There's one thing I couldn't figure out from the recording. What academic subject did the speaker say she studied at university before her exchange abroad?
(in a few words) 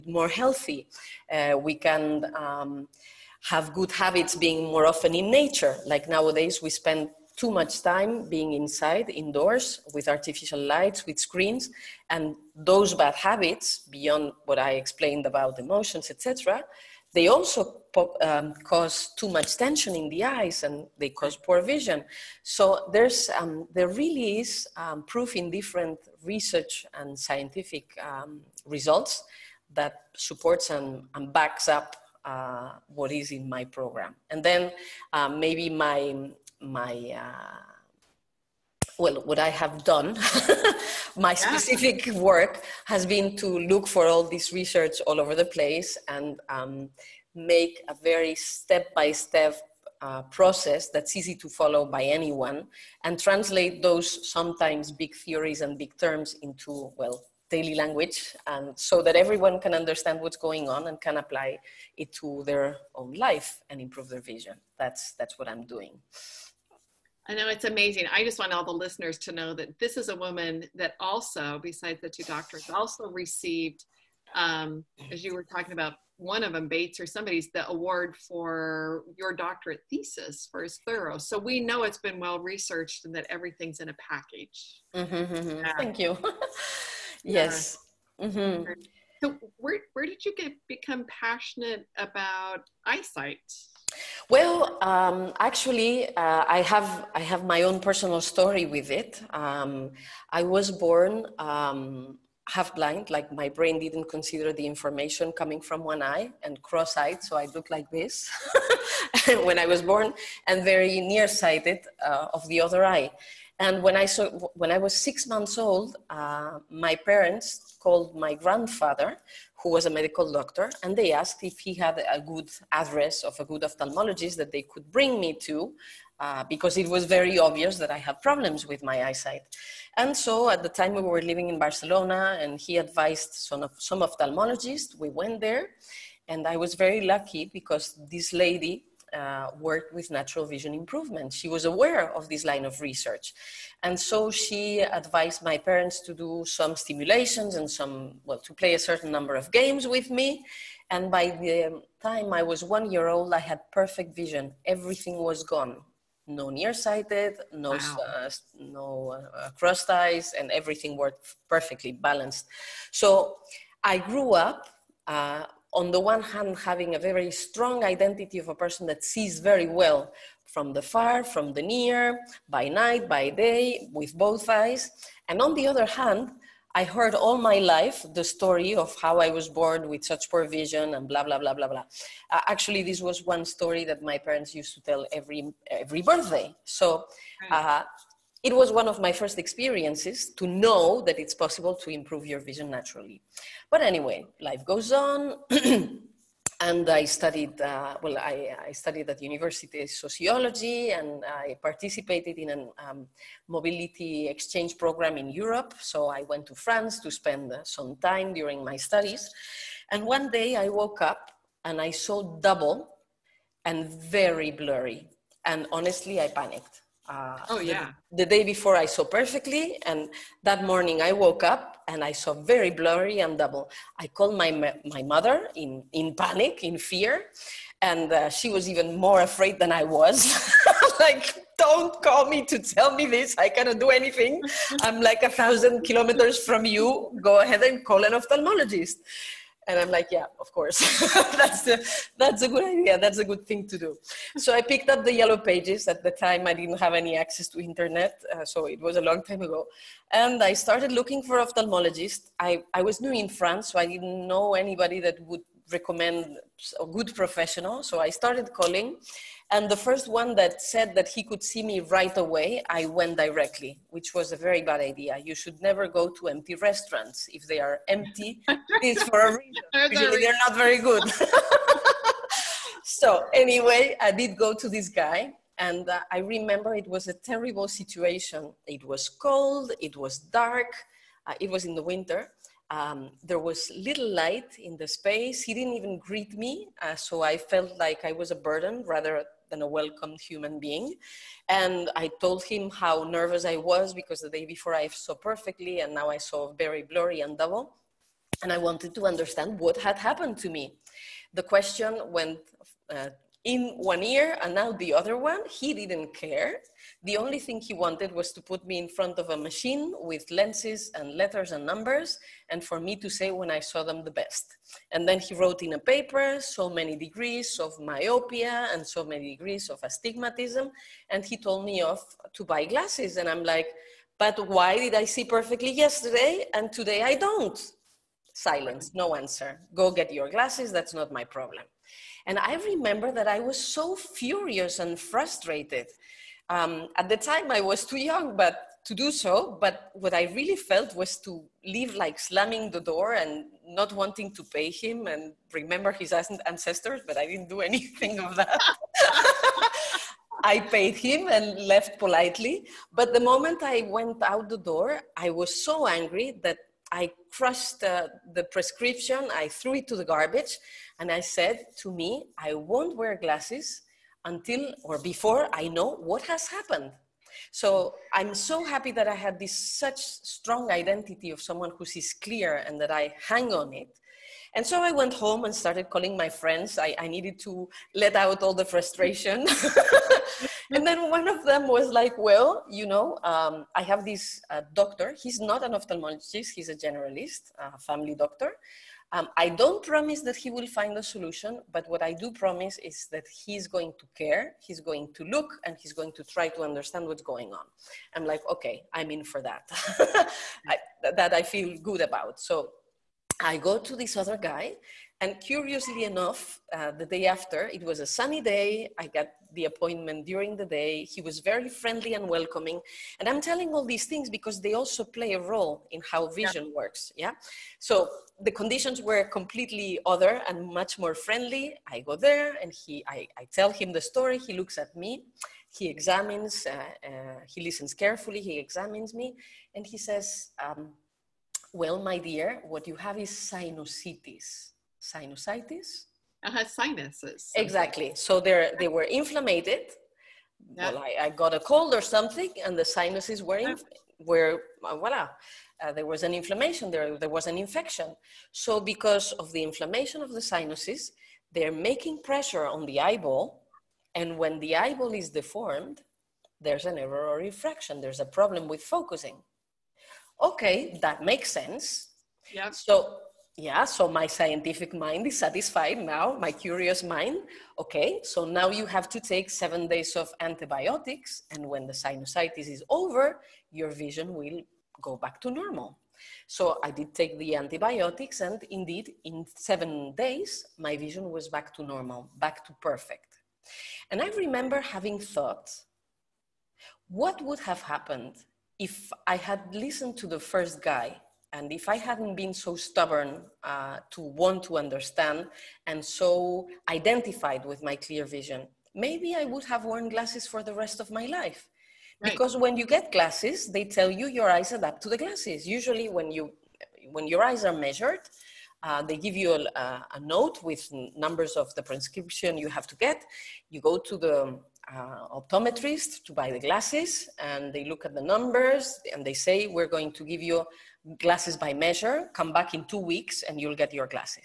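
Sociology.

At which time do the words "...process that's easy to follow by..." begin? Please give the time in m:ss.
0:50.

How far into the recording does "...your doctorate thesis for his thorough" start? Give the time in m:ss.
1:19.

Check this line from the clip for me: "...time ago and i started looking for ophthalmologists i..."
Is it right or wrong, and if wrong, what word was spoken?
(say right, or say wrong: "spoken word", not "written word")
right.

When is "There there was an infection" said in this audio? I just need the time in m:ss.
7:26.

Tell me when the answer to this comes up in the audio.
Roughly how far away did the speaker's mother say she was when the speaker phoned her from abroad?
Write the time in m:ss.
3:55.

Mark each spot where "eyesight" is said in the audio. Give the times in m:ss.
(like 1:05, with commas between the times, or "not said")
1:32, 2:09.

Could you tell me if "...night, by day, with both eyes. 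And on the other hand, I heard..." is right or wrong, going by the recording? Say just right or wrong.
right.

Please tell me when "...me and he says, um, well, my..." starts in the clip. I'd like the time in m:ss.
7:09.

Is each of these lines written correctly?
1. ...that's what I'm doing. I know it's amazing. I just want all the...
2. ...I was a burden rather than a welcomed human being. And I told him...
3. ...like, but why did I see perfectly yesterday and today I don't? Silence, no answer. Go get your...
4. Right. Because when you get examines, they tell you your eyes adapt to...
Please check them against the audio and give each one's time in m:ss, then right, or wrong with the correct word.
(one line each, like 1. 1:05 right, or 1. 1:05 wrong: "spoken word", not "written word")
1. 1:05 right
2. 4:48 right
3. 5:23 right
4. 8:22 wrong: "glasses", not "examines".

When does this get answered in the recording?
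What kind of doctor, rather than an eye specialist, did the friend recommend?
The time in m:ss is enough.
6:27.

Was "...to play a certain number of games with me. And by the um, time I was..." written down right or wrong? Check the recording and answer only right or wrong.
right.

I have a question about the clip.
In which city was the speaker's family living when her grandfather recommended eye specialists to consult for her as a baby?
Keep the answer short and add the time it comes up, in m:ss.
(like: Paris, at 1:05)
Barcelona, at 2:11.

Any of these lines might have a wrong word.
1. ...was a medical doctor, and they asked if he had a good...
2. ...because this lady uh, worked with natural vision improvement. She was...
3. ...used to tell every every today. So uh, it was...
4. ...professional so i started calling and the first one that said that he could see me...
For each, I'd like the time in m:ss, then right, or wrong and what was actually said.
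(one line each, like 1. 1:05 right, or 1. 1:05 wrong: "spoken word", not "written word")
1. 1:59 right
2. 2:17 right
3. 3:04 wrong: "birthday", not "today"
4. 4:17 right.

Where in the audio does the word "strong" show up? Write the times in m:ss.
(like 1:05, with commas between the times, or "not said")
2:47, 6:10.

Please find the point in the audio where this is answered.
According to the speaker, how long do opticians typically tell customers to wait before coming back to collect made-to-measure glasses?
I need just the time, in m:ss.
8:42.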